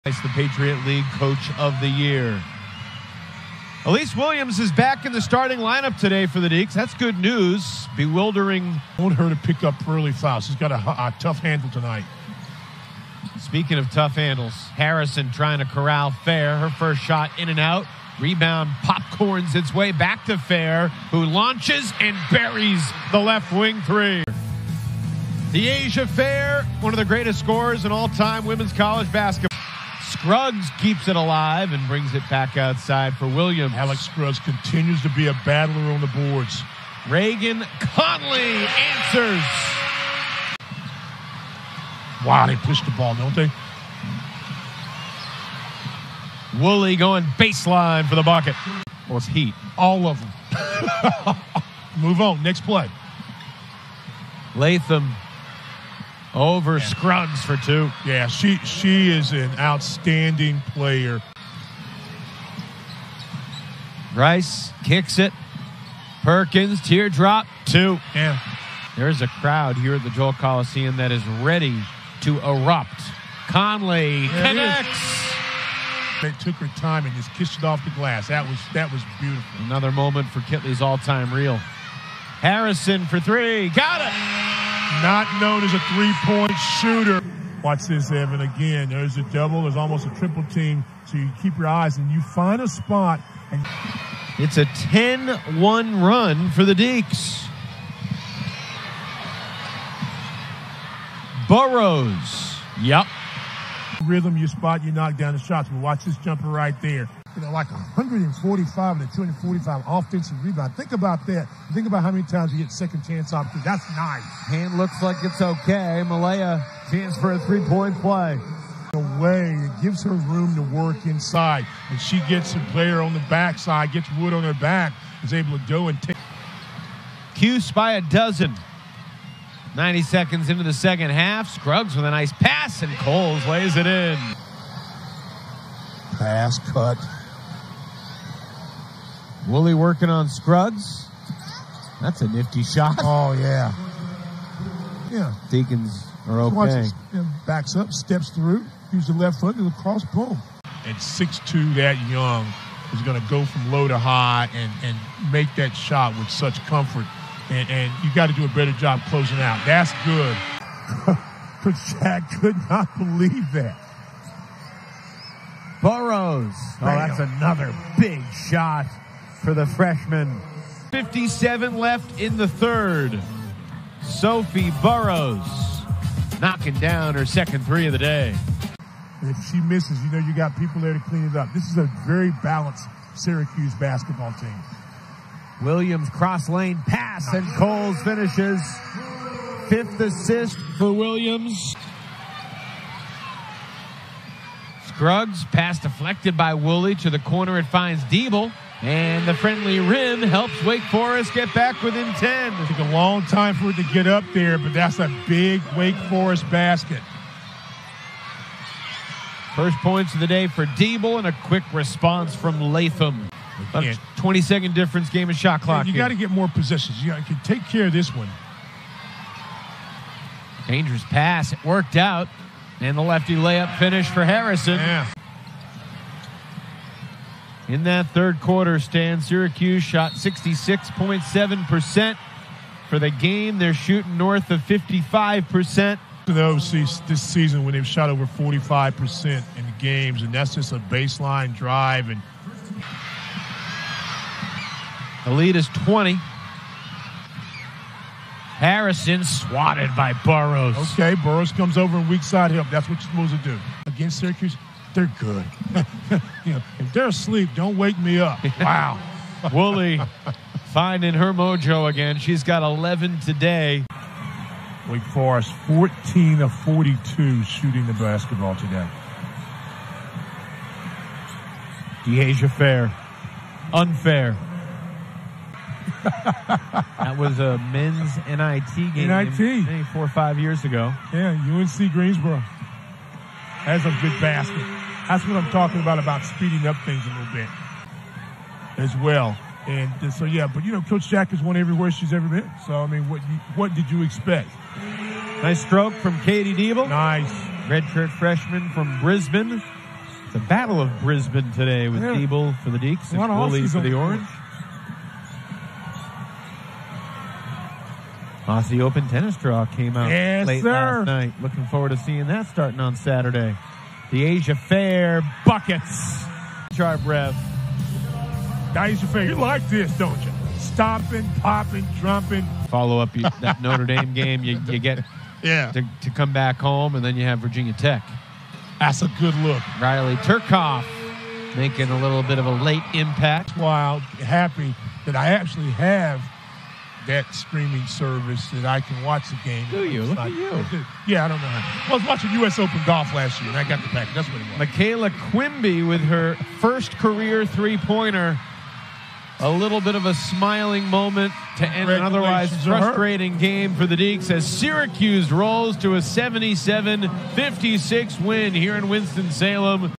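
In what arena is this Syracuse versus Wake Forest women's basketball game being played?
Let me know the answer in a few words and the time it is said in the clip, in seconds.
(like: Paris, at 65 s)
Joel Coliseum, at 70 s.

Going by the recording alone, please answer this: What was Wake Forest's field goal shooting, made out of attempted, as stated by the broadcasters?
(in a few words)
14 of 42.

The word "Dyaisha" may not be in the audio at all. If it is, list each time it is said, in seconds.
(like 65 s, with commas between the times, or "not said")
25 s, 272 s, 314 s, 318 s.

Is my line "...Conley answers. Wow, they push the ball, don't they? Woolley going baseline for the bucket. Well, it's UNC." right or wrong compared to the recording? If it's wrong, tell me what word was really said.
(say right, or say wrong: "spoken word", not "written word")
wrong: "Heat", not "UNC".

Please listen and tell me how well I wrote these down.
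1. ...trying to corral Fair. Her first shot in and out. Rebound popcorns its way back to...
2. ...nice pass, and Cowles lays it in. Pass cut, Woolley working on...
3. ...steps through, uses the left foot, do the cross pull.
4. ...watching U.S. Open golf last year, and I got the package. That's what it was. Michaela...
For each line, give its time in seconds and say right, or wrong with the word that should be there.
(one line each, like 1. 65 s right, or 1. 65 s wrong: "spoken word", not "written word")
1. 15 s right
2. 132 s right
3. 147 s right
4. 342 s right.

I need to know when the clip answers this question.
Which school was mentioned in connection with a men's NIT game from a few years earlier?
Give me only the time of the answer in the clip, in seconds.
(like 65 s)
281 s.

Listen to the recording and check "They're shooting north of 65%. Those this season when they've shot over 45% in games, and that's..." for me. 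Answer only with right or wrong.
wrong.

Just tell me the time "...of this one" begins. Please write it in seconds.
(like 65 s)
217 s.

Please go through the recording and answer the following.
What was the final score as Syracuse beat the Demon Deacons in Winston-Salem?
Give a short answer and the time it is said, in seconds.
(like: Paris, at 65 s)
77-56, at 356 s.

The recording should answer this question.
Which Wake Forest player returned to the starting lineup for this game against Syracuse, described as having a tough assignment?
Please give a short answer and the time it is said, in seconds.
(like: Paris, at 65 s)
Elise Williams, at 3 s.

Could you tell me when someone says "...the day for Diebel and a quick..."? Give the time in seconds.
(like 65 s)
210 s.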